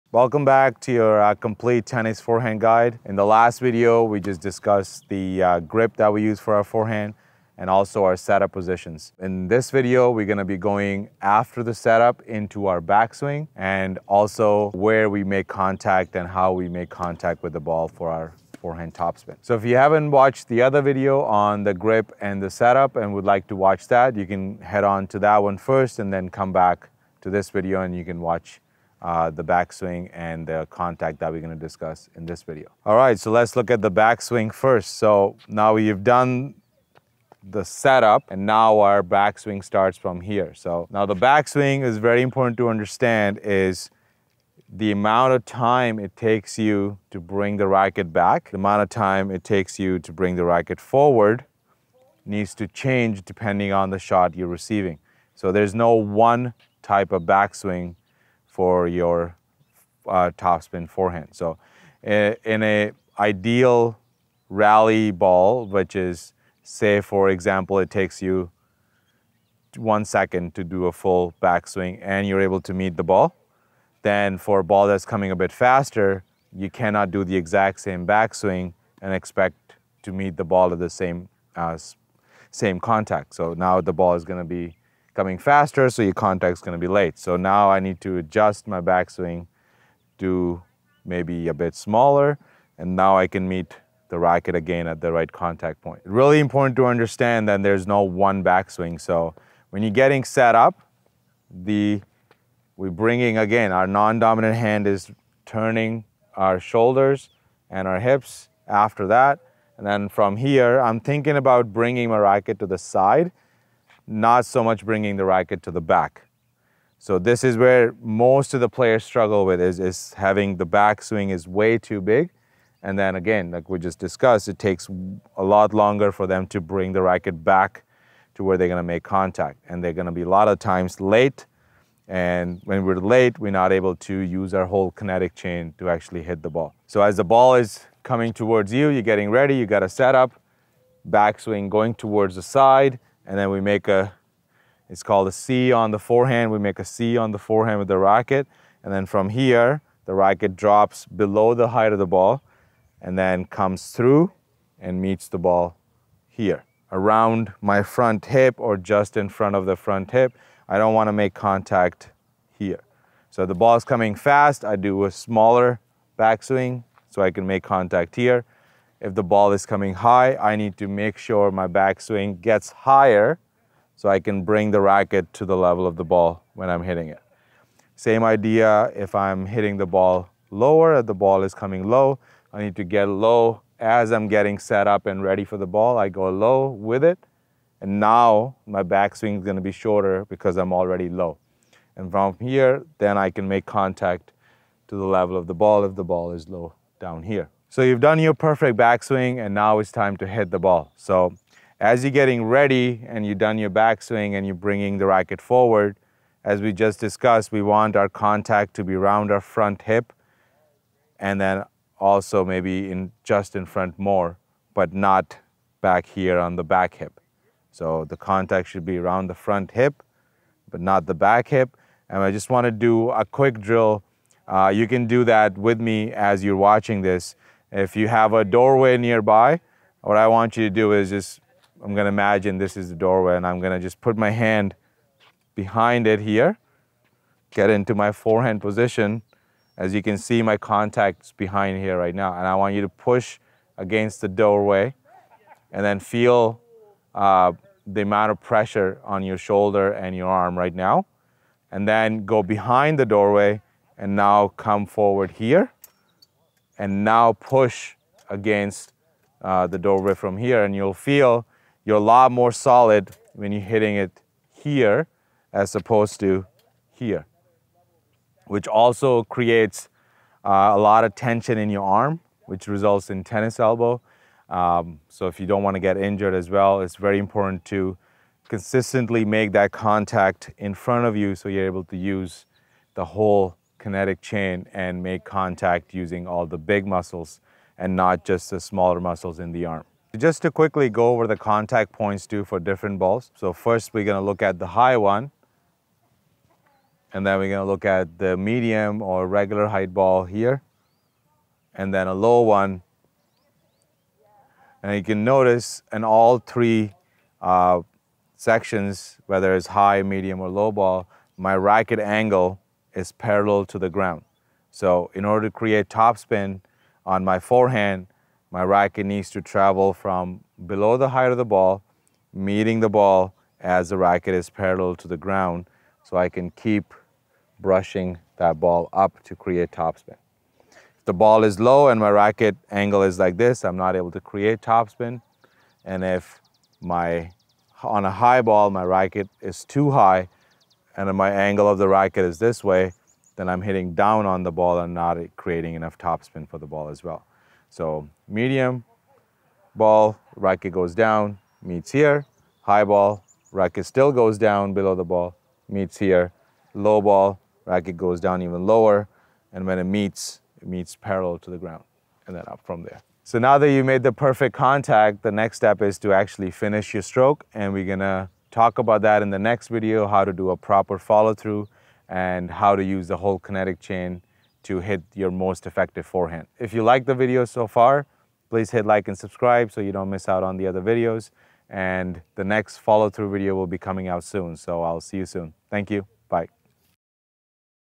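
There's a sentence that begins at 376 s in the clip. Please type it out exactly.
If you like the video so far, please hit like and subscribe so you don't miss out on the other videos.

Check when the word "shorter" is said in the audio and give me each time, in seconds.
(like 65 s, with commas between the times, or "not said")
189 s.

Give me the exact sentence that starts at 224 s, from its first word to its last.
Uh, you can do that with me as you're watching this.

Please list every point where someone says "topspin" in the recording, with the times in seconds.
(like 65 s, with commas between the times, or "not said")
18 s, 60 s, 315 s, 329 s, 334 s, 345 s.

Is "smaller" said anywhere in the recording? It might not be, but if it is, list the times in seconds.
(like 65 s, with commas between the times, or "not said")
91 s, 165 s, 288 s.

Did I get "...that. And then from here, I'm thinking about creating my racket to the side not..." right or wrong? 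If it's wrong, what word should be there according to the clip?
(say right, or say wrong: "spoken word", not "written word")
wrong: "bringing", not "creating".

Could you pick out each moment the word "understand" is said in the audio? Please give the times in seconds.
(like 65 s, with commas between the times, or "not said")
42 s, 96 s.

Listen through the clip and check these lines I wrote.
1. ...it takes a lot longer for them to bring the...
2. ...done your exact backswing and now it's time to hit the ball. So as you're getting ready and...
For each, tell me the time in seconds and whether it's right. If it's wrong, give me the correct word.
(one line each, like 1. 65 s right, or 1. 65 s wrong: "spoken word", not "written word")
1. 124 s right
2. 198 s wrong: "perfect", not "exact".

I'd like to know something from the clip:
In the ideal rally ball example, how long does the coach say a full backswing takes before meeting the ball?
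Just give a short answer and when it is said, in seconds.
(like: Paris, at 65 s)
1 second, at 69 s.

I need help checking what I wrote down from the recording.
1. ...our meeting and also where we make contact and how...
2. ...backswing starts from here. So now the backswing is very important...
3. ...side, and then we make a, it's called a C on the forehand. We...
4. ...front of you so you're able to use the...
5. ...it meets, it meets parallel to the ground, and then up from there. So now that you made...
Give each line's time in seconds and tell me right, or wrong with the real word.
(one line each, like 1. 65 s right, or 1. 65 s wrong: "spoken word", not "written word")
1. 12 s wrong: "backswing", not "meeting"
2. 39 s right
3. 142 s right
4. 280 s right
5. 359 s right.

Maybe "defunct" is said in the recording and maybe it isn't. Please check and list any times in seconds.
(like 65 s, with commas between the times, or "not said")
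not said.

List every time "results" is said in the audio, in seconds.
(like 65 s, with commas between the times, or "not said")
272 s.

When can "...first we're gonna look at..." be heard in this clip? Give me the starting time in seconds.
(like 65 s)
293 s.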